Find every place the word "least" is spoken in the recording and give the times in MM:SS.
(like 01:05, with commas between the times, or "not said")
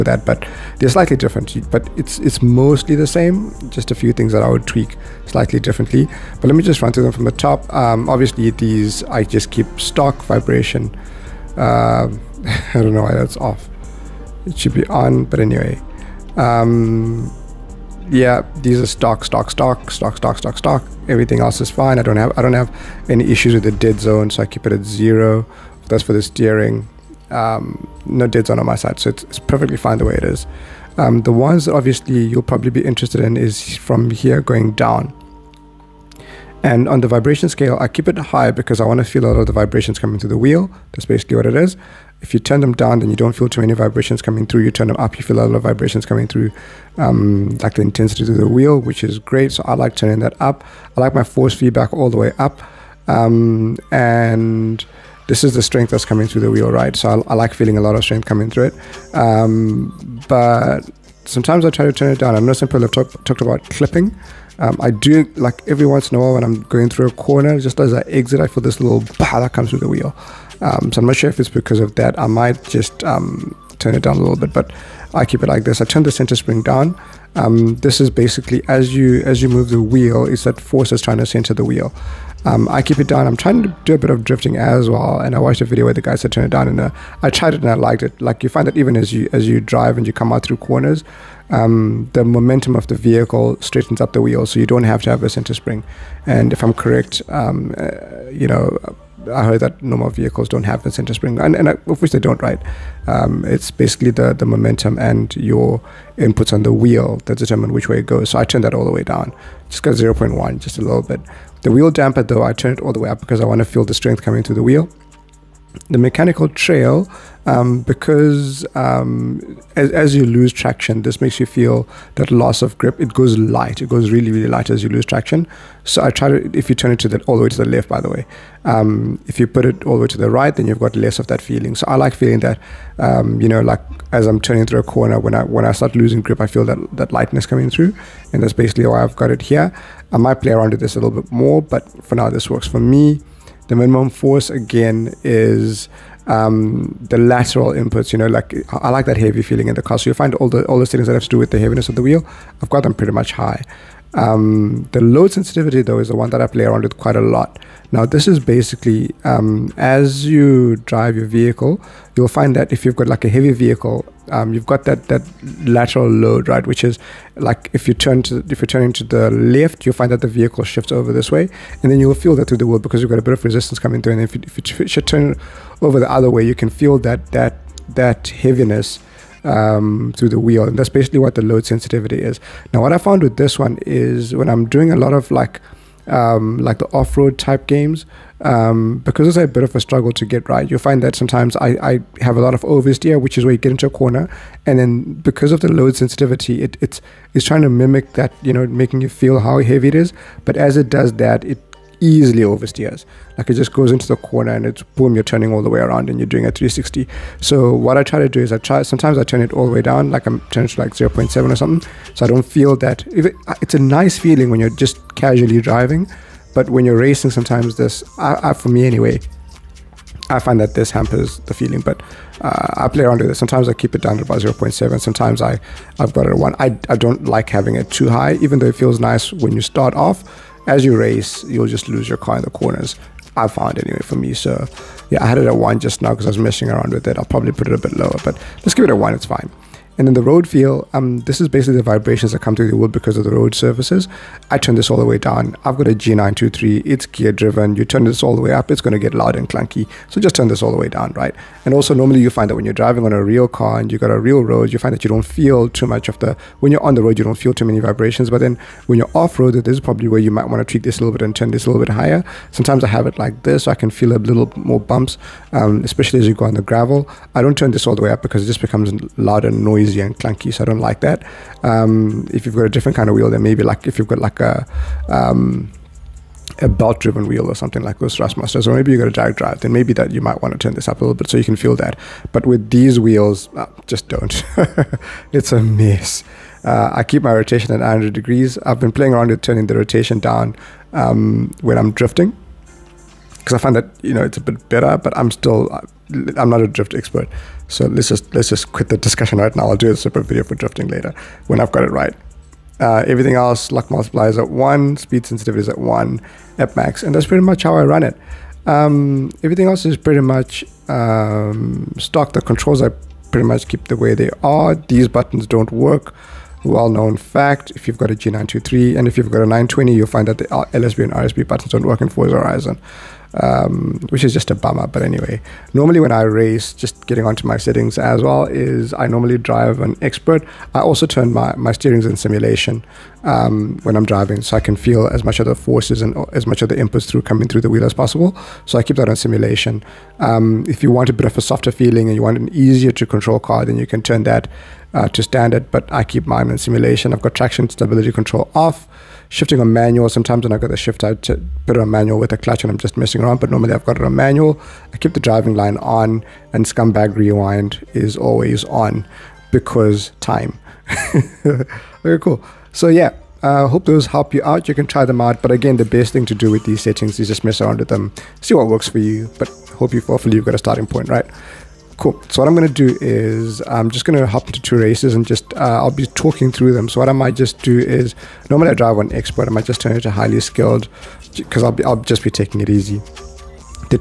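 not said.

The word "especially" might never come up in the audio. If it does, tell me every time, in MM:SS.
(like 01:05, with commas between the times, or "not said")
04:25.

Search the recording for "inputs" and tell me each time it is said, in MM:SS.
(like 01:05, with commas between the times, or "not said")
01:46, 02:27, 05:36.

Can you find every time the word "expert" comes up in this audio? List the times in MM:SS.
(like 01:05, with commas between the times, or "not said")
04:56, 05:30, 06:19.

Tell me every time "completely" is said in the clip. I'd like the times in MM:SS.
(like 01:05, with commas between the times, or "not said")
not said.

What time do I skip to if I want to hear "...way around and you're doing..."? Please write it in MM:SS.
03:25.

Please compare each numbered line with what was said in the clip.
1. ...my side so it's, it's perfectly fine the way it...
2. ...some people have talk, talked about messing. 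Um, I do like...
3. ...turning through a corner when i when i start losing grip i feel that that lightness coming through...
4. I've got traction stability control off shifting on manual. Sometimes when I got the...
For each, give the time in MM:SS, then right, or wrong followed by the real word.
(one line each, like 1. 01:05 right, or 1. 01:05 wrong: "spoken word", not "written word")
1. 00:28 right
2. 01:02 wrong: "clipping", not "messing"
3. 02:14 right
4. 05:47 right.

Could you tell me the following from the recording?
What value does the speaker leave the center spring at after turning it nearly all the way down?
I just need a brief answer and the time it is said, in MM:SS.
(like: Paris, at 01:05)
0.1, at 01:49.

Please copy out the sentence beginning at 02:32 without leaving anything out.
I've got them pretty much high.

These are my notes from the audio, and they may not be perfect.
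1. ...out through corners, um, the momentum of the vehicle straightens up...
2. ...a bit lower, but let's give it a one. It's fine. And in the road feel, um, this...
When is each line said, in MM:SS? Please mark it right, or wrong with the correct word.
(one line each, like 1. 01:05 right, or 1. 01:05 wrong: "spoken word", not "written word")
1. 01:30 right
2. 03:57 right.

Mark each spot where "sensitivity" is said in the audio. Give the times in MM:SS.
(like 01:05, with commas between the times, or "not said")
02:35, 03:01, 03:15, 05:05.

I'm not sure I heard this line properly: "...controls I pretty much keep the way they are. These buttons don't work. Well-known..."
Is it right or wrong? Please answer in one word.
right.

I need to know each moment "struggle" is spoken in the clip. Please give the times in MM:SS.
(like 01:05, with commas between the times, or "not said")
03:09.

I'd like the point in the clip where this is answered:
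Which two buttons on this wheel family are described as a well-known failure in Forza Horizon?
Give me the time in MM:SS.
05:20.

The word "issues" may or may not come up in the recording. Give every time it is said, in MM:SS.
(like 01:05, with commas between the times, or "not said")
00:23.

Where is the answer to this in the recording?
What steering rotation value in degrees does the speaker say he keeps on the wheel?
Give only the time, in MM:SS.
04:47.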